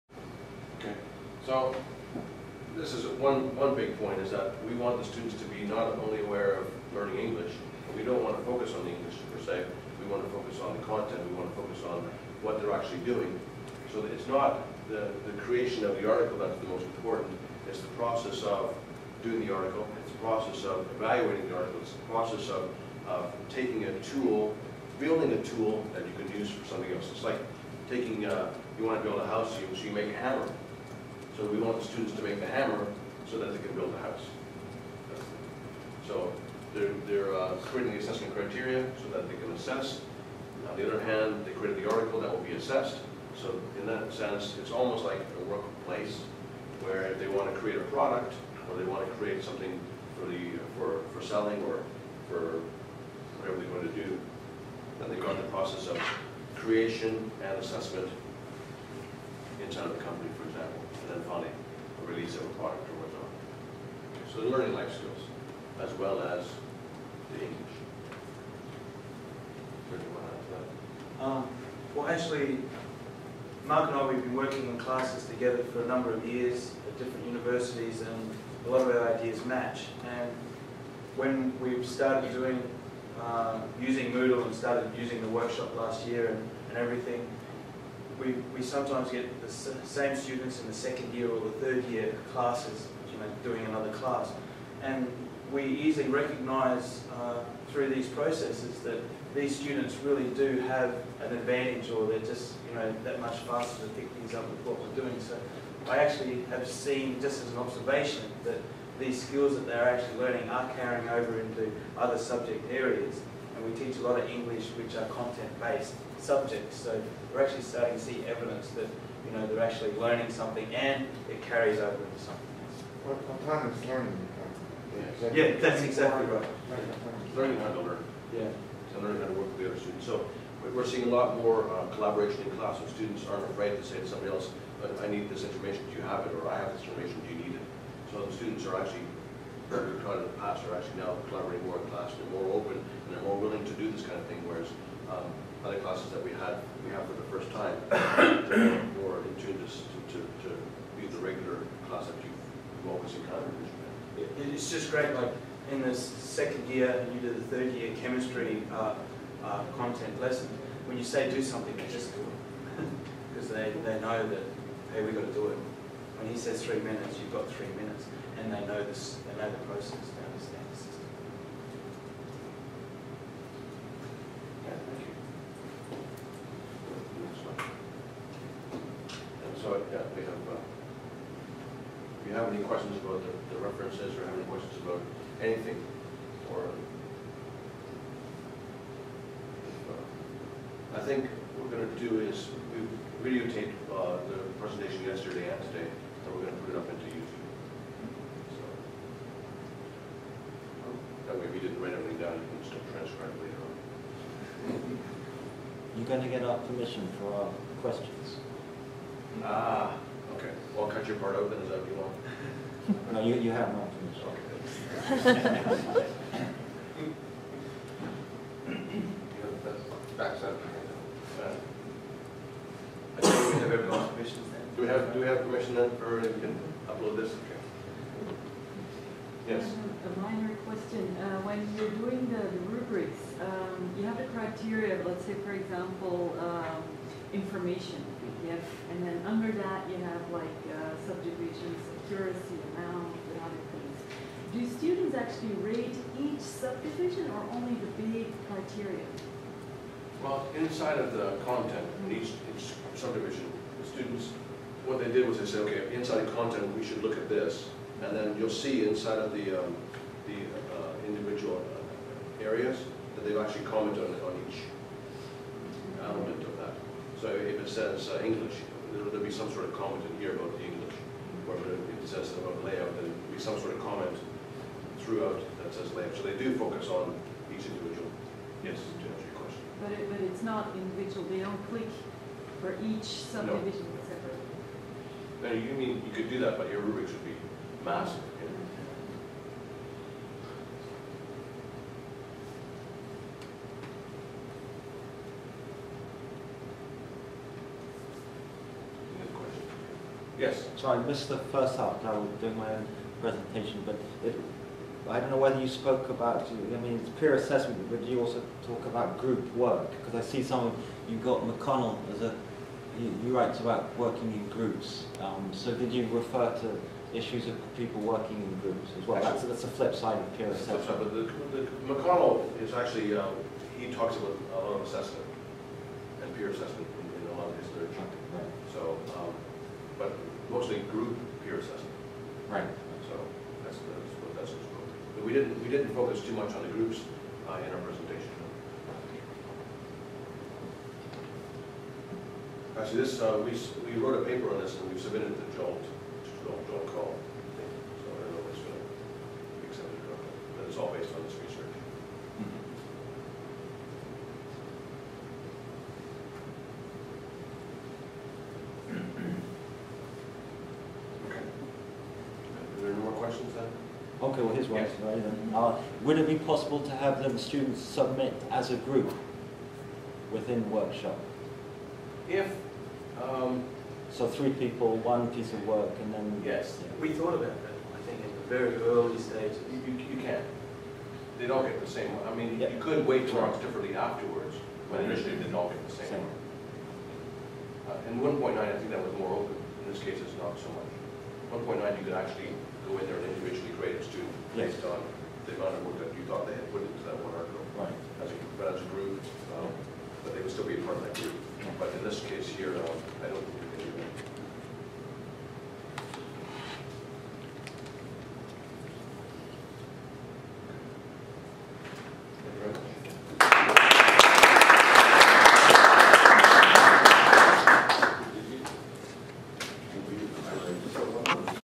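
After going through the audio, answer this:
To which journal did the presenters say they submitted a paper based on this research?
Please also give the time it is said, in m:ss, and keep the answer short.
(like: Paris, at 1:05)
JOLT, at 5:45.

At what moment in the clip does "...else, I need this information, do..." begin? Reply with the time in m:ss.
2:14.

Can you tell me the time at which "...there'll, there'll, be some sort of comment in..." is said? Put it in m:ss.
4:28.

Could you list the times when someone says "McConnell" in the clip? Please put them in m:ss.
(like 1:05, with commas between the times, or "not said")
5:11, 5:21.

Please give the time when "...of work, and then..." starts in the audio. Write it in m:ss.
6:15.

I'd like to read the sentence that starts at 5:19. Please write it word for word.
That's, that's the flip side of peer assessment.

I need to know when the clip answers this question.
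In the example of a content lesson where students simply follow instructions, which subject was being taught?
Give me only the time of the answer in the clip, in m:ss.
2:38.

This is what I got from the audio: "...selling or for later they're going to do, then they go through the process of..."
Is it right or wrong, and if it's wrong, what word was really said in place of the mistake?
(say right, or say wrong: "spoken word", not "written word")
wrong: "whatever", not "later".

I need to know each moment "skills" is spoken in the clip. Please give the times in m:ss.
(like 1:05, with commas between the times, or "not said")
1:04, 1:49.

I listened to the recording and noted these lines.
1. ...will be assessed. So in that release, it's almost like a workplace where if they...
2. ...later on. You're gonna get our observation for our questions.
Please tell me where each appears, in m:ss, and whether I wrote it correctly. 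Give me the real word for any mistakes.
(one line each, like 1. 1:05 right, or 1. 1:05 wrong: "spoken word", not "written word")
1. 0:42 wrong: "sense", not "release"
2. 3:23 wrong: "permission", not "observation".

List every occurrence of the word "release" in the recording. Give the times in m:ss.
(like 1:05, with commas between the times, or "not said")
1:02.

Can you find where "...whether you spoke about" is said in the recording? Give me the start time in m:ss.
5:05.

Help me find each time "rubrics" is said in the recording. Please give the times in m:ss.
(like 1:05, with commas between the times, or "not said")
3:52, 4:46.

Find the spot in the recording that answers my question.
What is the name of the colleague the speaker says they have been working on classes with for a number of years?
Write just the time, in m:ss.
1:13.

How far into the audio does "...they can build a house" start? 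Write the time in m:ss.
0:33.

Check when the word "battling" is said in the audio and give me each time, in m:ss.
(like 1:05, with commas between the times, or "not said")
not said.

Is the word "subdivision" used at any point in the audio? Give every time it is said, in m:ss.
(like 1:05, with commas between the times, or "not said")
4:01, 4:06, 4:12, 4:43.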